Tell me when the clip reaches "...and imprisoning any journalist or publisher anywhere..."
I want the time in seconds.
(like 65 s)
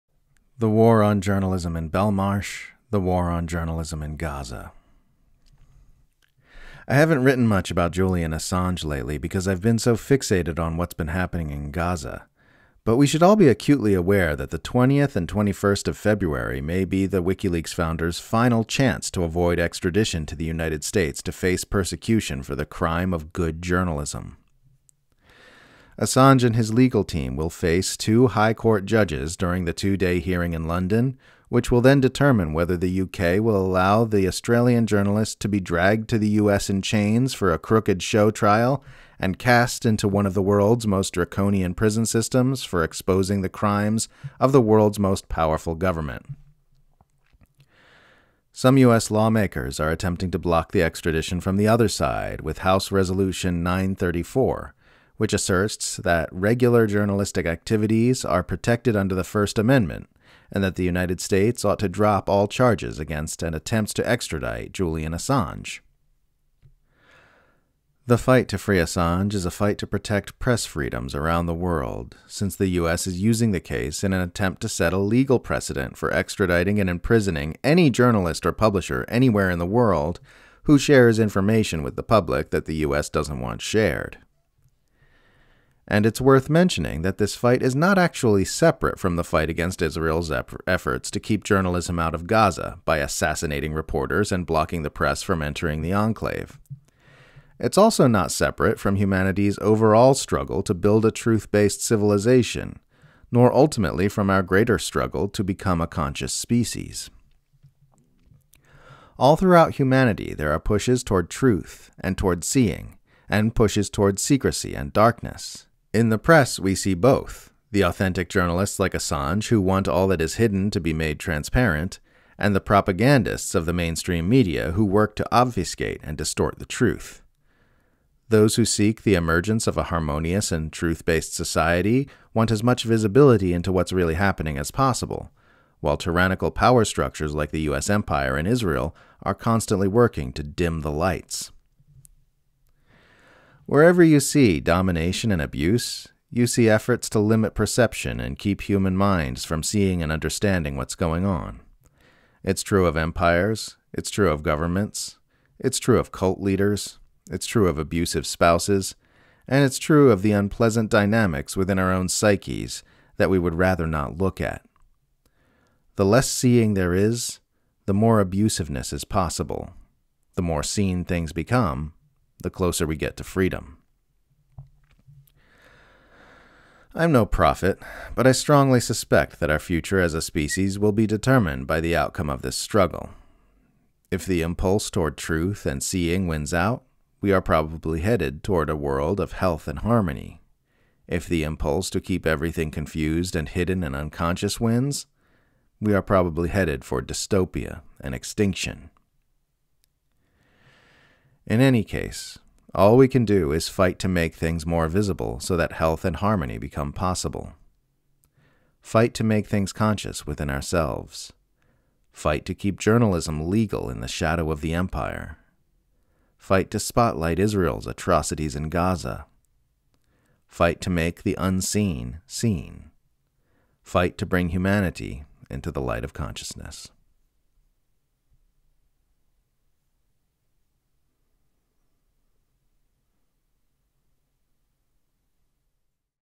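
76 s.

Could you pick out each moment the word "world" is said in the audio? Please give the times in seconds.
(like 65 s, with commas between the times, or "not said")
40 s, 44 s, 71 s, 79 s, 188 s.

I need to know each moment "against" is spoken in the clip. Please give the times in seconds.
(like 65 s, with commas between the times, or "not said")
62 s, 89 s.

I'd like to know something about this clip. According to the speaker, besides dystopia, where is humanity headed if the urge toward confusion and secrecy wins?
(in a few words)
Extinction.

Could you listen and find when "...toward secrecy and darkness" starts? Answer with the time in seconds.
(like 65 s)
113 s.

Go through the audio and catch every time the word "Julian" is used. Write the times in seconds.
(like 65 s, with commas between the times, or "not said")
7 s, 64 s.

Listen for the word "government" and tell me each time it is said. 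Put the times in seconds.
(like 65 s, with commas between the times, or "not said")
45 s, 154 s.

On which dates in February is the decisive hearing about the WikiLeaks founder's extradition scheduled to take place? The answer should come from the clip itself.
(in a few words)
20th and 21st.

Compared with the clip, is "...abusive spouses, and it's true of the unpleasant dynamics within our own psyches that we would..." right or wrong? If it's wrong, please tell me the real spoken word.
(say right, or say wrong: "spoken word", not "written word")
right.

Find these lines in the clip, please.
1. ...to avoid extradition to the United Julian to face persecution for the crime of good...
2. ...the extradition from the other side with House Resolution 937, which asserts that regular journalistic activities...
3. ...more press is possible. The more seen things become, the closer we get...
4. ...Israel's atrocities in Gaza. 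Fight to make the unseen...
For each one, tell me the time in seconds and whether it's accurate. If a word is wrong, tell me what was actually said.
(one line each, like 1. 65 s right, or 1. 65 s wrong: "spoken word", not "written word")
1. 19 s wrong: "States", not "Julian"
2. 50 s wrong: "934", not "937"
3. 167 s wrong: "abusiveness", not "press"
4. 217 s right.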